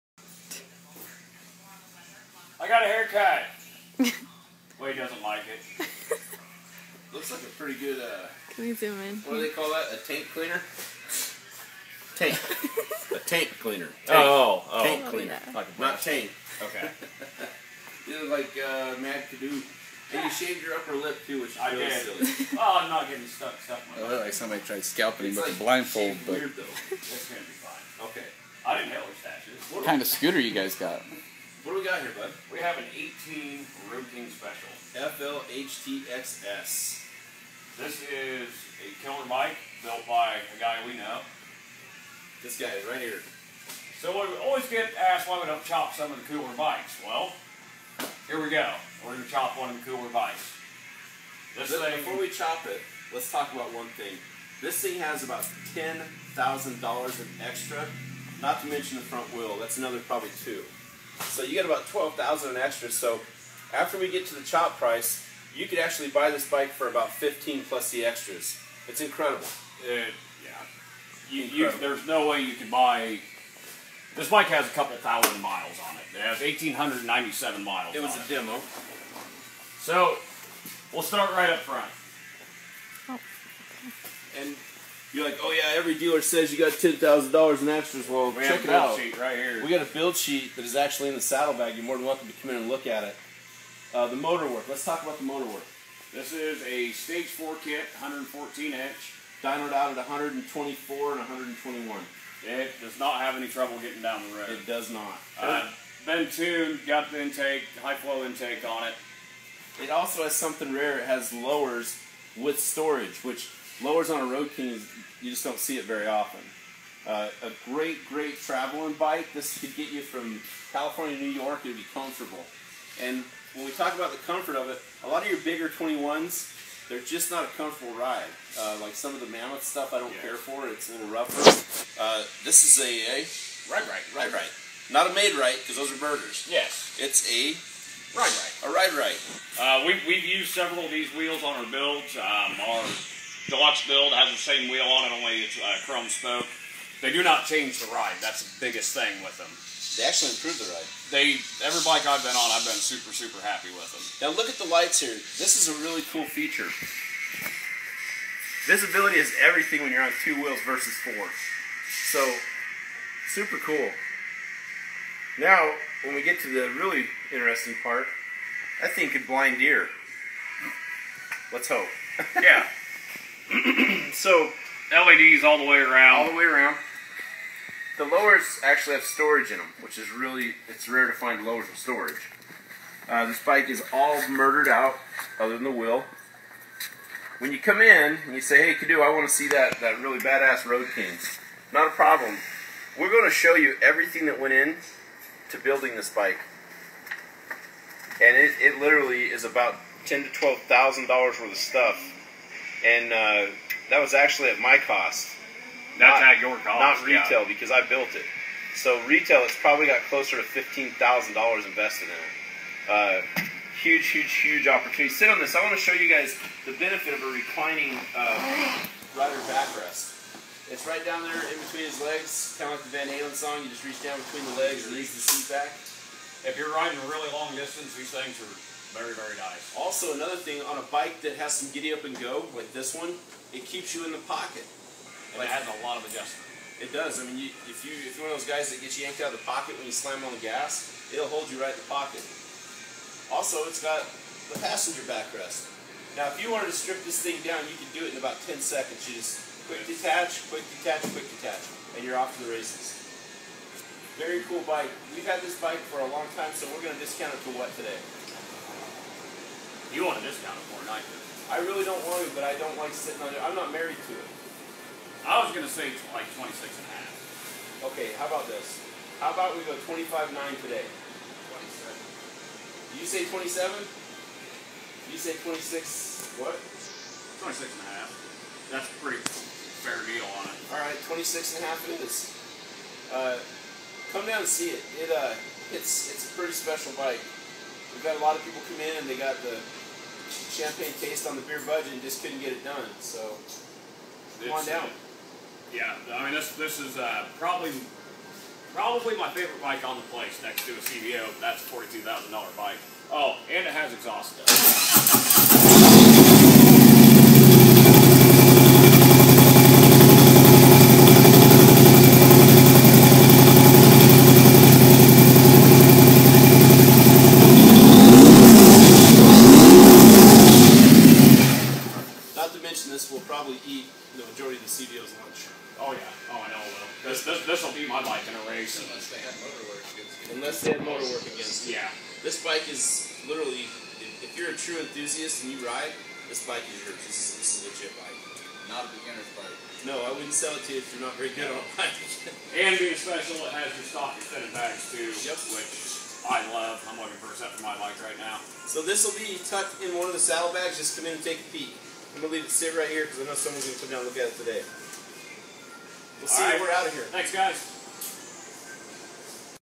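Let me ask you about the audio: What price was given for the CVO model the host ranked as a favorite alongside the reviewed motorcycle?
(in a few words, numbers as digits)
$42,000.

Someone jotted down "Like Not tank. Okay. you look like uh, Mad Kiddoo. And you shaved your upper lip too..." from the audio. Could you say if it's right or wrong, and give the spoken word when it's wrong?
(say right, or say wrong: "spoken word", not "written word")
right.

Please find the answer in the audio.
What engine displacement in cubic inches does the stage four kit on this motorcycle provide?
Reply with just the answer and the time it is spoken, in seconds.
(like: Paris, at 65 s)
114 inch, at 97 s.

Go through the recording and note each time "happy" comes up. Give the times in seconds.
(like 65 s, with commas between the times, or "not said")
153 s.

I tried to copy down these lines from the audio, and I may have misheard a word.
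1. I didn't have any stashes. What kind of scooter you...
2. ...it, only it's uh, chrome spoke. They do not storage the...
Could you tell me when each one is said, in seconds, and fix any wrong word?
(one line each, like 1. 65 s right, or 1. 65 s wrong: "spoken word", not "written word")
1. 28 s right
2. 145 s wrong: "change", not "storage".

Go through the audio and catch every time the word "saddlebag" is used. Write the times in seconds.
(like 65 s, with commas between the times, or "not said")
91 s, 350 s.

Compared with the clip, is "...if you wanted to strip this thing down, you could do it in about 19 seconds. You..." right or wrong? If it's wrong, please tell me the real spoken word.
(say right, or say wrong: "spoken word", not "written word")
wrong: "10", not "19".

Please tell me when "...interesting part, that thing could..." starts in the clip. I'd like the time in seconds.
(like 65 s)
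167 s.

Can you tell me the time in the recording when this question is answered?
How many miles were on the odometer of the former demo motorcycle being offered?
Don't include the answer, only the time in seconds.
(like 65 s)
76 s.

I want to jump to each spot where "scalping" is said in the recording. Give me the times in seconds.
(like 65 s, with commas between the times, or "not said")
24 s.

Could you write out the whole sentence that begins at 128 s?
Uh, like some of the Mammoth stuff I don't care for.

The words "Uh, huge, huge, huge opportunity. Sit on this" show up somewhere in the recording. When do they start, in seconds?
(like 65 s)
212 s.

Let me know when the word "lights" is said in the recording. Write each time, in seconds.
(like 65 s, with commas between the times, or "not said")
154 s.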